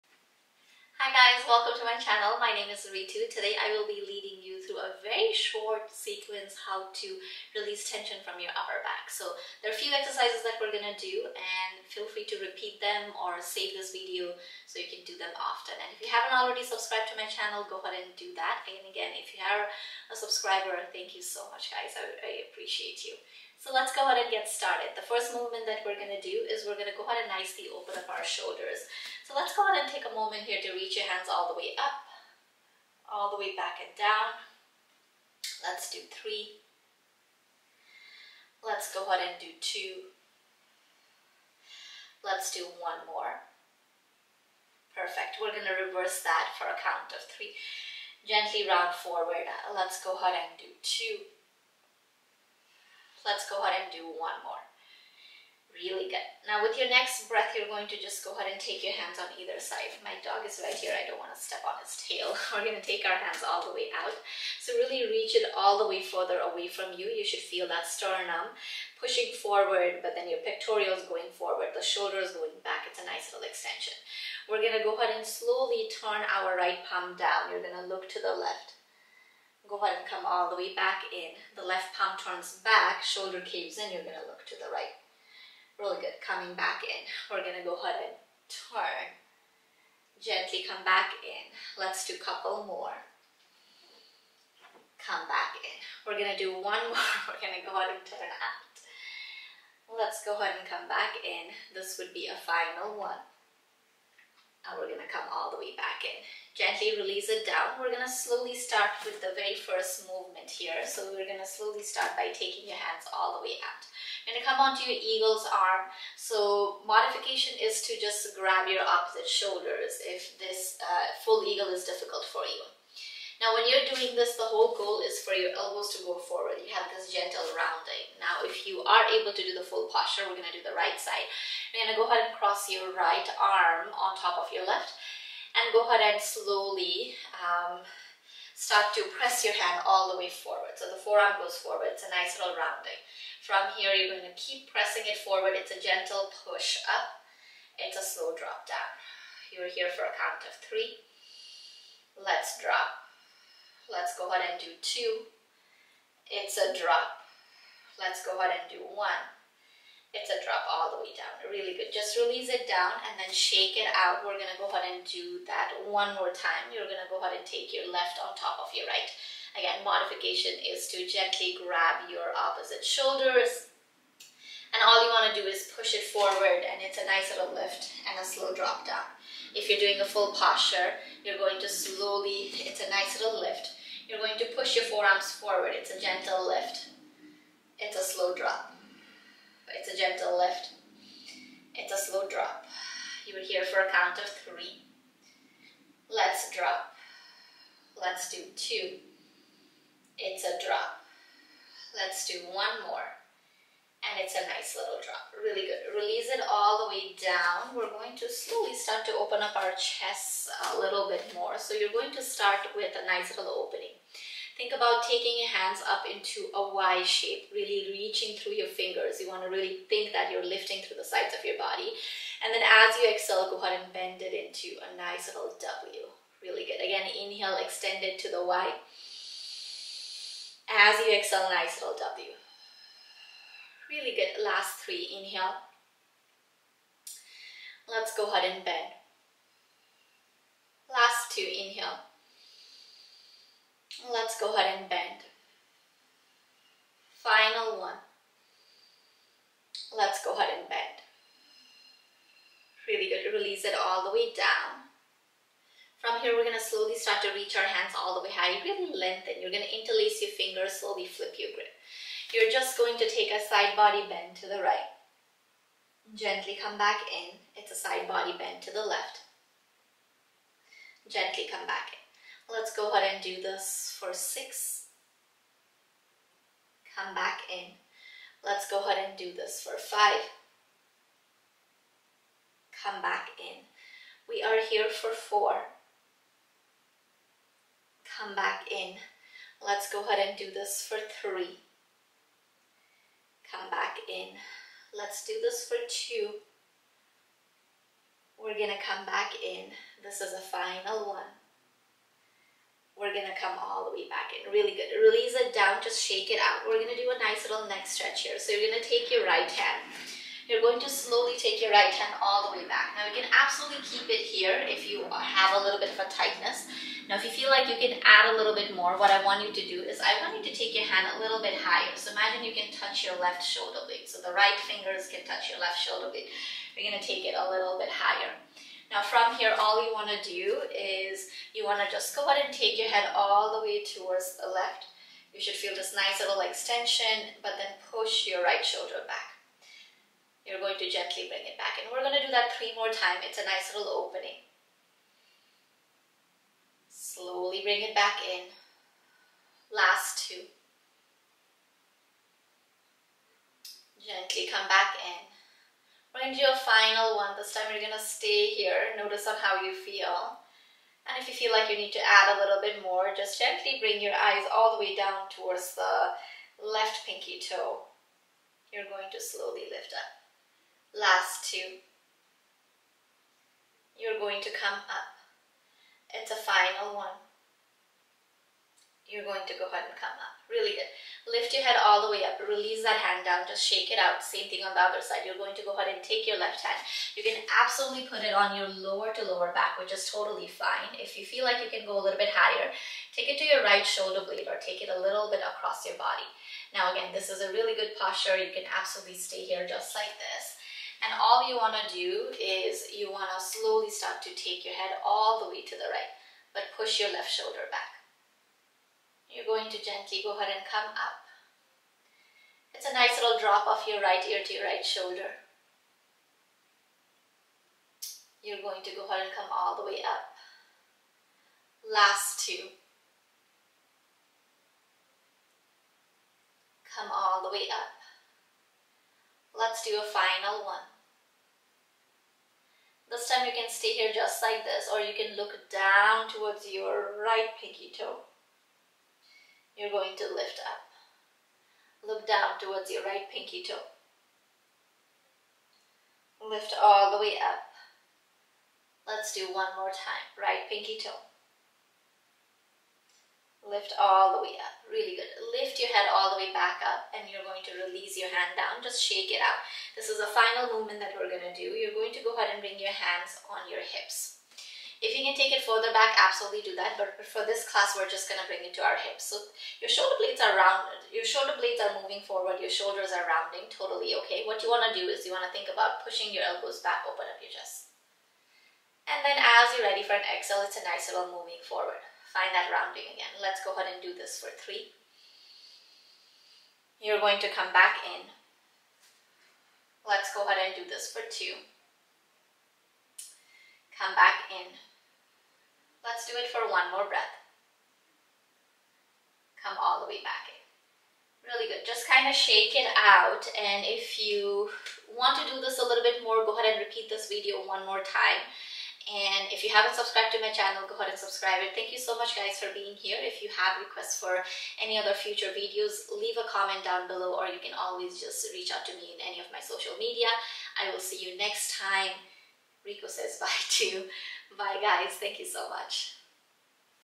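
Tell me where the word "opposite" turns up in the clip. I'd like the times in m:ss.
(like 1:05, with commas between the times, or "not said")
1:58, 2:52.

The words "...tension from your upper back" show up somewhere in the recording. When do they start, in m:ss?
0:07.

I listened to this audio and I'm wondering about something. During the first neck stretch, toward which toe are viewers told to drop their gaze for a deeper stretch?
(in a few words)
left pinky toe.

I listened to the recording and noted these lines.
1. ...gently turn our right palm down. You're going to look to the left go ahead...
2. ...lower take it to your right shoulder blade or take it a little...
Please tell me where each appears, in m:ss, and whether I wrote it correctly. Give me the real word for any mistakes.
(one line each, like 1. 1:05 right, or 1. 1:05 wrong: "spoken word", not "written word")
1. 1:15 wrong: "slowly", not "gently"
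2. 6:32 wrong: "higher", not "lower".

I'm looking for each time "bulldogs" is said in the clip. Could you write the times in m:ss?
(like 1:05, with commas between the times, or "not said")
not said.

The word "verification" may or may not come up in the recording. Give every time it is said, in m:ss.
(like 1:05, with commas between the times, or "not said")
not said.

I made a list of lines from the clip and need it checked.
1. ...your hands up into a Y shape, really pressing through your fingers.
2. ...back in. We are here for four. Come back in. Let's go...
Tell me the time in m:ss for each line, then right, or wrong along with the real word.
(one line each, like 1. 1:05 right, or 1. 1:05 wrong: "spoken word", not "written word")
1. 3:35 wrong: "reaching", not "pressing"
2. 4:43 right.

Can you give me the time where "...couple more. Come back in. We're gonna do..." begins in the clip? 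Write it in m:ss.
1:32.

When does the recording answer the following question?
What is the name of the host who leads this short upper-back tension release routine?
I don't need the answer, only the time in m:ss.
0:02.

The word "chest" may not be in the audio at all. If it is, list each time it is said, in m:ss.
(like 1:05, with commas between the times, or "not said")
3:29, 7:57.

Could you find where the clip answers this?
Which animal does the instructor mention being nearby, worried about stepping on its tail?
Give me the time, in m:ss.
1:00.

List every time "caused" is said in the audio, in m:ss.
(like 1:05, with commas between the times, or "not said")
not said.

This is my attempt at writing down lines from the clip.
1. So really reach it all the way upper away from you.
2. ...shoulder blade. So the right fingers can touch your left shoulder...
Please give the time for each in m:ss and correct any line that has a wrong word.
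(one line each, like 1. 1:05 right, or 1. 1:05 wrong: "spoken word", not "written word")
1. 1:04 wrong: "further", not "upper"
2. 5:23 right.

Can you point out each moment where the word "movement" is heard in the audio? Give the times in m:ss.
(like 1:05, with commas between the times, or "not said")
0:25, 1:50, 7:40.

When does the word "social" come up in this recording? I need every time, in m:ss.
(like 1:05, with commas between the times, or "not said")
8:39.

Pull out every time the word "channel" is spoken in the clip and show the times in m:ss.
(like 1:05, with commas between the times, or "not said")
0:02, 0:17, 8:30.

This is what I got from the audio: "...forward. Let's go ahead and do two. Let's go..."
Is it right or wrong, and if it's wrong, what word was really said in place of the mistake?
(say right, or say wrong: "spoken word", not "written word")
right.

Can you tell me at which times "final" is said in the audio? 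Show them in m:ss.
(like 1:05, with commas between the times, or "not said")
1:42, 4:07, 5:00, 5:56, 6:16, 7:10, 7:40.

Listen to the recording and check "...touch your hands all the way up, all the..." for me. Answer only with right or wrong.
wrong.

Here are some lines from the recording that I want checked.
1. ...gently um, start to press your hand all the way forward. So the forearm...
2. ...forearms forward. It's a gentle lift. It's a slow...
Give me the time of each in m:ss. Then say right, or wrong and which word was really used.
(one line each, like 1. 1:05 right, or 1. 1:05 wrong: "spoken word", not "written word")
1. 2:16 wrong: "slowly", not "gently"
2. 3:04 right.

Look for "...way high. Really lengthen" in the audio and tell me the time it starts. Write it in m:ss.
4:18.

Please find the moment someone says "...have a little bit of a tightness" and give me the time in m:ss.
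5:15.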